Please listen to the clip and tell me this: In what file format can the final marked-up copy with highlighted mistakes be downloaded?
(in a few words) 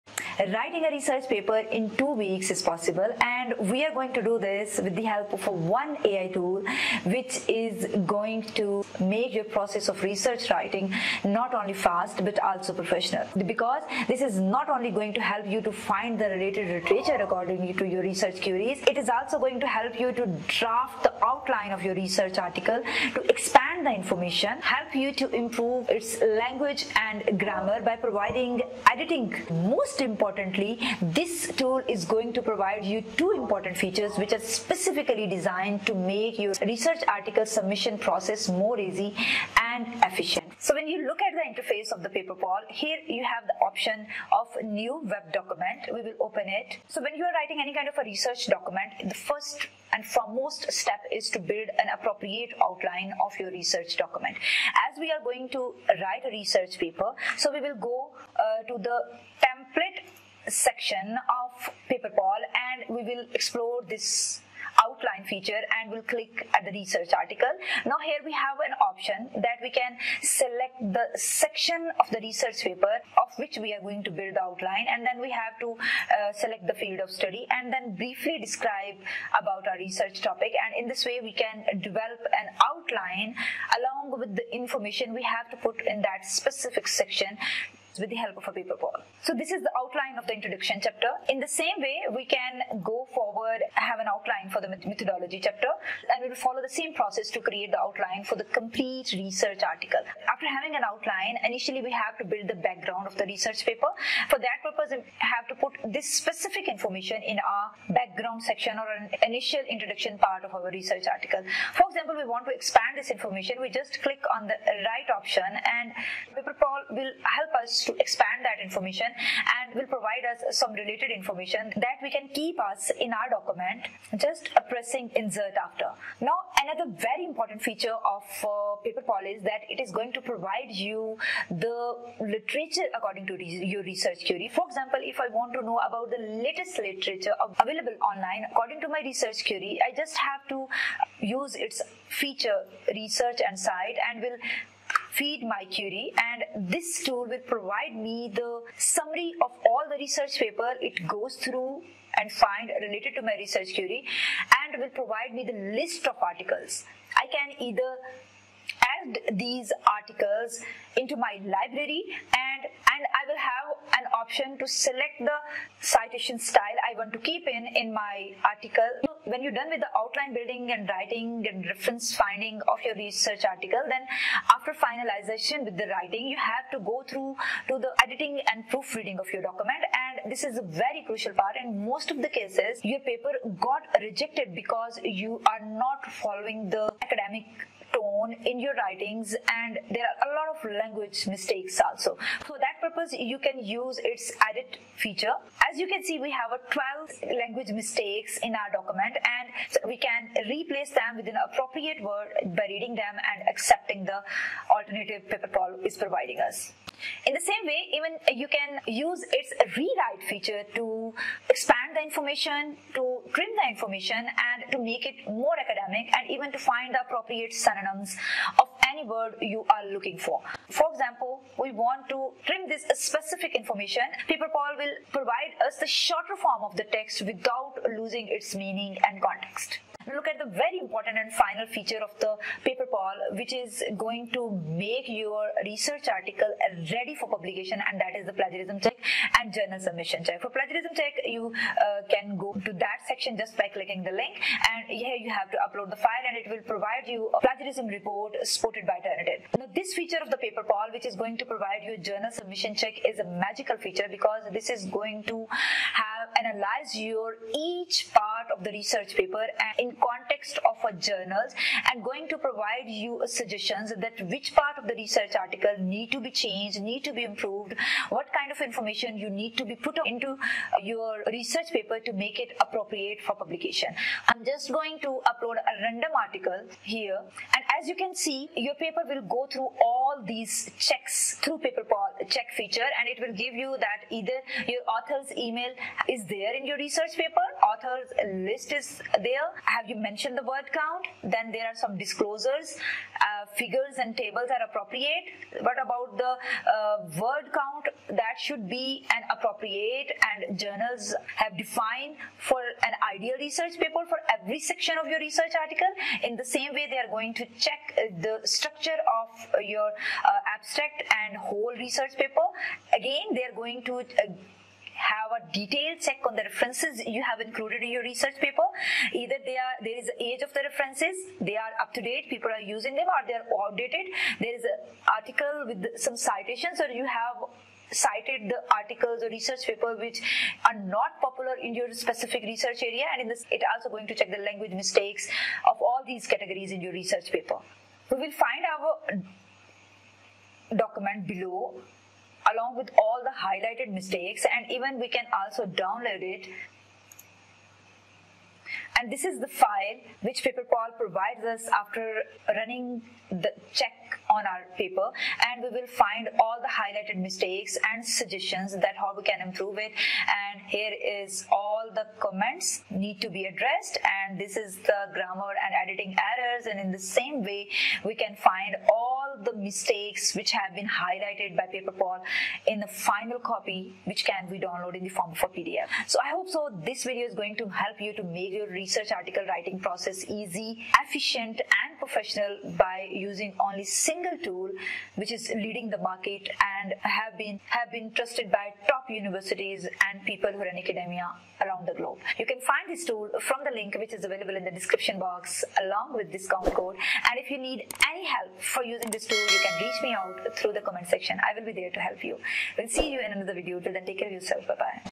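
PDF.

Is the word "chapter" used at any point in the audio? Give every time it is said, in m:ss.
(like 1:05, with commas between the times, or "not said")
1:30, 1:35.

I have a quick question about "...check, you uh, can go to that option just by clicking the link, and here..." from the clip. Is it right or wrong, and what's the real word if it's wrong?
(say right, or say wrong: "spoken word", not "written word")
wrong: "section", not "option".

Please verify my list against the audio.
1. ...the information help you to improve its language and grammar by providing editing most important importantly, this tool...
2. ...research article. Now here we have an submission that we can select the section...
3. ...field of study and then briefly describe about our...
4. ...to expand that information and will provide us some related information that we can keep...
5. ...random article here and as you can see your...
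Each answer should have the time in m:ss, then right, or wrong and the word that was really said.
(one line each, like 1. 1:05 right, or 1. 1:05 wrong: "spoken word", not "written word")
1. 0:23 right
2. 1:06 wrong: "option", not "submission"
3. 1:16 right
4. 1:57 right
5. 4:35 right.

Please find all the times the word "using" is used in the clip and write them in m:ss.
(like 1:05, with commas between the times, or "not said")
5:22, 6:23, 6:38.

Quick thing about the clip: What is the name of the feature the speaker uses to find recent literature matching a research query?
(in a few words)
research and cite.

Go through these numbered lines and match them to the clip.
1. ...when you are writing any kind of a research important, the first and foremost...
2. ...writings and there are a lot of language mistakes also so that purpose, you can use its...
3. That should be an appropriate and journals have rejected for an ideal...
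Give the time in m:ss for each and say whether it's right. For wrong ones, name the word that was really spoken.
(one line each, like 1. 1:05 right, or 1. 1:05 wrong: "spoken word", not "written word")
1. 0:47 wrong: "document", not "important"
2. 3:08 right
3. 4:58 wrong: "defined", not "rejected".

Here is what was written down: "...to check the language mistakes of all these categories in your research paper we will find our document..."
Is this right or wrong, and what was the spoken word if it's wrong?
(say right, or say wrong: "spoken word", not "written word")
right.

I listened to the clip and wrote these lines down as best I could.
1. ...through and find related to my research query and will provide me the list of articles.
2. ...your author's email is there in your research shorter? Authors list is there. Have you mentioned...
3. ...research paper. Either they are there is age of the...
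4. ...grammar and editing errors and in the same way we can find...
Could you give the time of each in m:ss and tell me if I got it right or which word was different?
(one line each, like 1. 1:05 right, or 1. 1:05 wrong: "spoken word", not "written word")
1. 2:31 right
2. 4:44 wrong: "paper", not "shorter"
3. 5:18 right
4. 6:05 right.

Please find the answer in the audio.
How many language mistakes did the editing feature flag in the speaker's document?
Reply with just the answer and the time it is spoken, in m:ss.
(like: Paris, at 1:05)
12, at 3:17.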